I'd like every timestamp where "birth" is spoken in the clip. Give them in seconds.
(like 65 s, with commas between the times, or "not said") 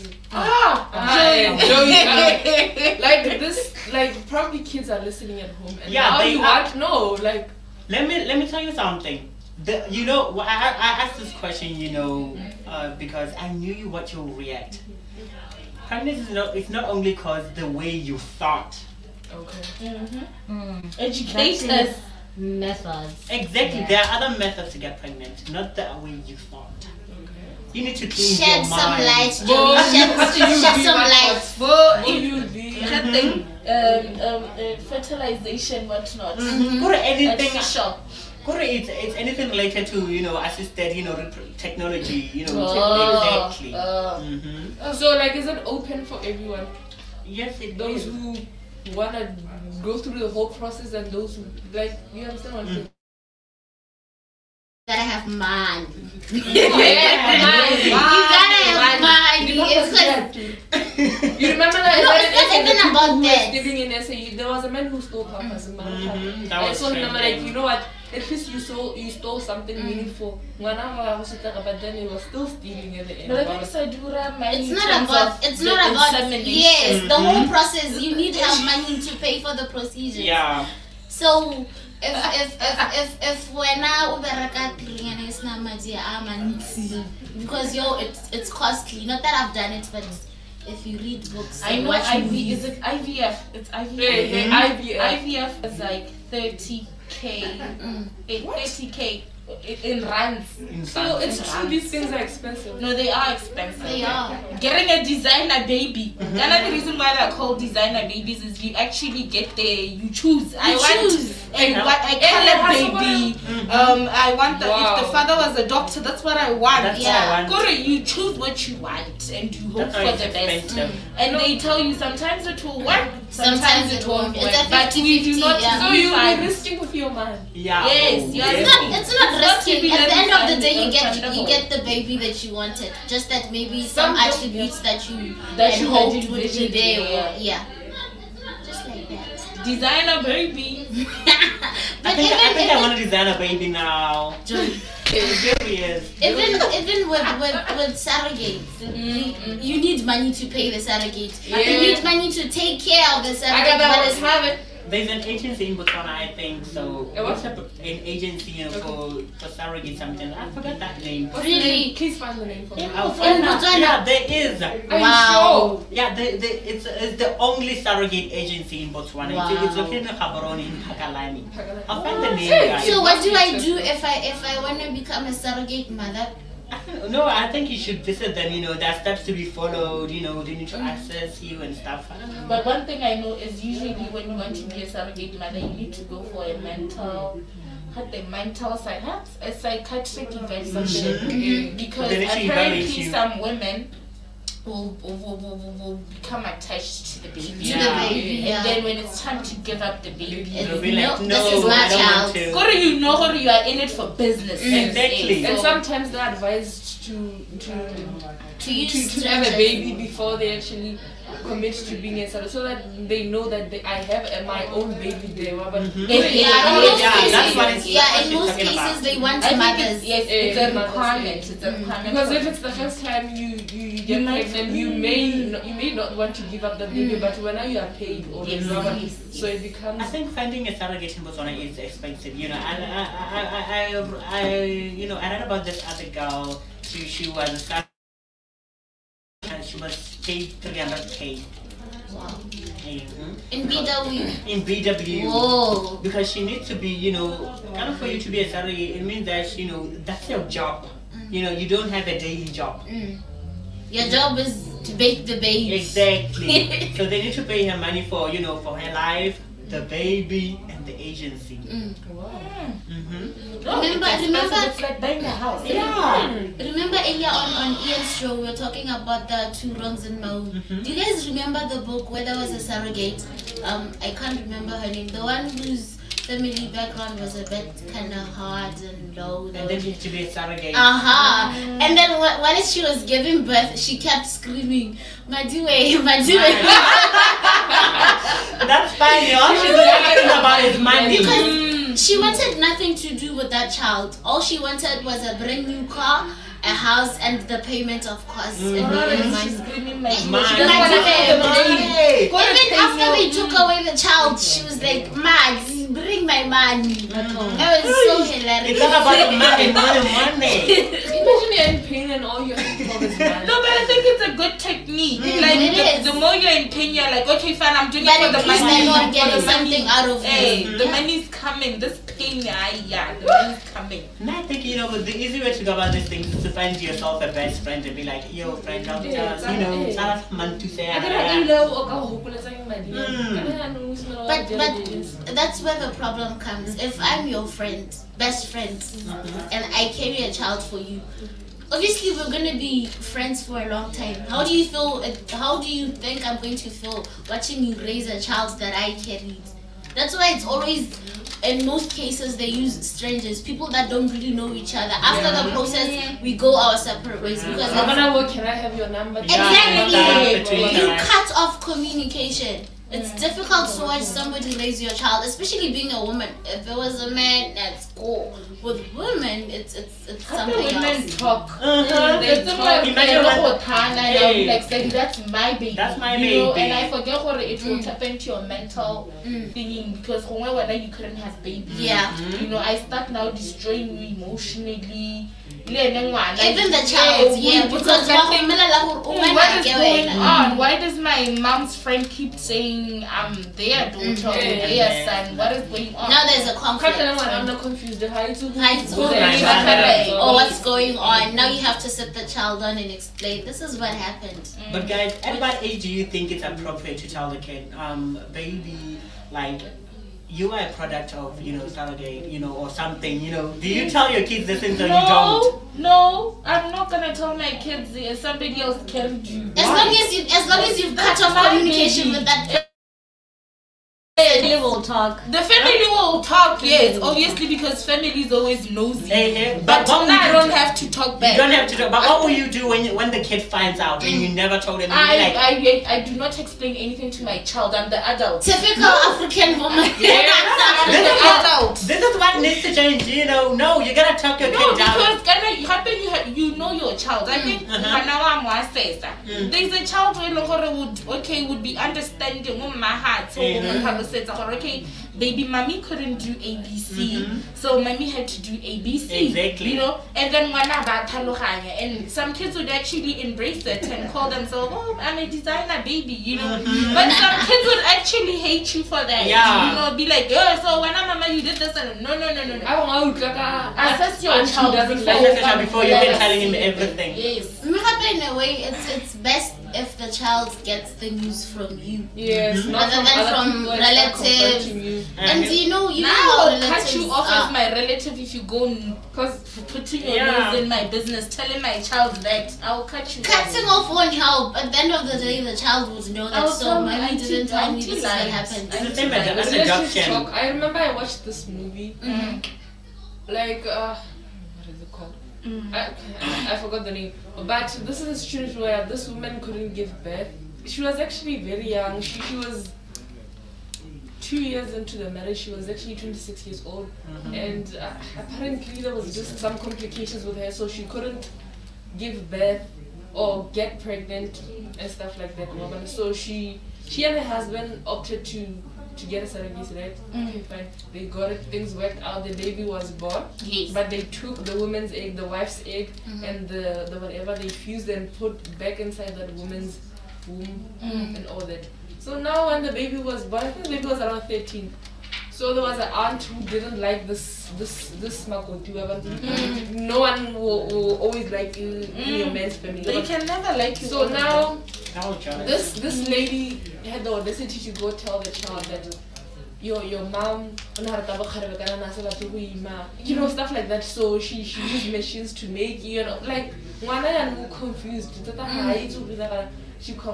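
283 s, 510 s, 522 s.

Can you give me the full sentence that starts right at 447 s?
I mm, think I'm one says there's a child who okay would be understanding.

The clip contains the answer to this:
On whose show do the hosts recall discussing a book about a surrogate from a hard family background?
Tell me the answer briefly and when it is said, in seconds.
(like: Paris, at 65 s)
Ian's show, at 267 s.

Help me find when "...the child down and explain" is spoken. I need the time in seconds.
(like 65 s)
402 s.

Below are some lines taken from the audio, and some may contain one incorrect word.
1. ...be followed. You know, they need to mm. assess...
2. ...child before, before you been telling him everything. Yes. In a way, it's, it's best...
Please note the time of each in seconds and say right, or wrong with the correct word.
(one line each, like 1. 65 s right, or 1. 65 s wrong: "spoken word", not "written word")
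1. 179 s wrong: "access", not "assess"
2. 474 s right.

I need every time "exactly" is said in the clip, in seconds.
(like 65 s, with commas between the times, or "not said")
23 s, 43 s, 204 s, 255 s, 359 s, 459 s.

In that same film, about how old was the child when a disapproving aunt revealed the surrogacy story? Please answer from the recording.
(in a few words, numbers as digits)
13.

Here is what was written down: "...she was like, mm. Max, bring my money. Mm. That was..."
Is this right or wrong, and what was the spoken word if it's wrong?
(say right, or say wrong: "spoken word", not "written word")
right.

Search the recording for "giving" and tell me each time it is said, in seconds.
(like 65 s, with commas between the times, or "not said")
63 s, 283 s.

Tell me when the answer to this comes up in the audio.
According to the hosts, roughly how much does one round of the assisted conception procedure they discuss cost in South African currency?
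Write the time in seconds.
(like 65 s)
96 s.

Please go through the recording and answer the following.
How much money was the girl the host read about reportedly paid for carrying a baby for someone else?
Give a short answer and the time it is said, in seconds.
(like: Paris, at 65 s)
300k, at 240 s.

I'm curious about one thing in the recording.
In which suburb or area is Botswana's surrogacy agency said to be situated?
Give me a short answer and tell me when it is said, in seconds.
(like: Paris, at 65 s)
Phakalane, at 170 s.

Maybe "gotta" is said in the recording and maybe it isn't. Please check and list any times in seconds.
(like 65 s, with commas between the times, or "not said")
54 s, 59 s, 443 s.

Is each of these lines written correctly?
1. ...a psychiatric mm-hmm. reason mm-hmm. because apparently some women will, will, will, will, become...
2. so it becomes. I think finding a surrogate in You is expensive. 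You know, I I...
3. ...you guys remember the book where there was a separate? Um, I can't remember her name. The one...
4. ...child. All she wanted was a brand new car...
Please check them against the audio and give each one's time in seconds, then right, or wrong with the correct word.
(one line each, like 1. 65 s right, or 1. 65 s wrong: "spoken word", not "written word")
1. 189 s wrong: "evaluation", not "reason"
2. 229 s wrong: "Botswana", not "You"
3. 270 s wrong: "surrogate", not "separate"
4. 293 s right.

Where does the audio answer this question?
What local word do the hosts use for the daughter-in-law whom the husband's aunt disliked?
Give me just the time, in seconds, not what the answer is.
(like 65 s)
548 s.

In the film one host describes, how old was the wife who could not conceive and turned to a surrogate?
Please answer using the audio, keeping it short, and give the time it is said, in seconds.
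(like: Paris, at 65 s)
26, at 515 s.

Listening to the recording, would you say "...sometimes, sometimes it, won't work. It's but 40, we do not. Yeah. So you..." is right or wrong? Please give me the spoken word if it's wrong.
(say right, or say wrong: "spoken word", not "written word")
wrong: "50", not "40".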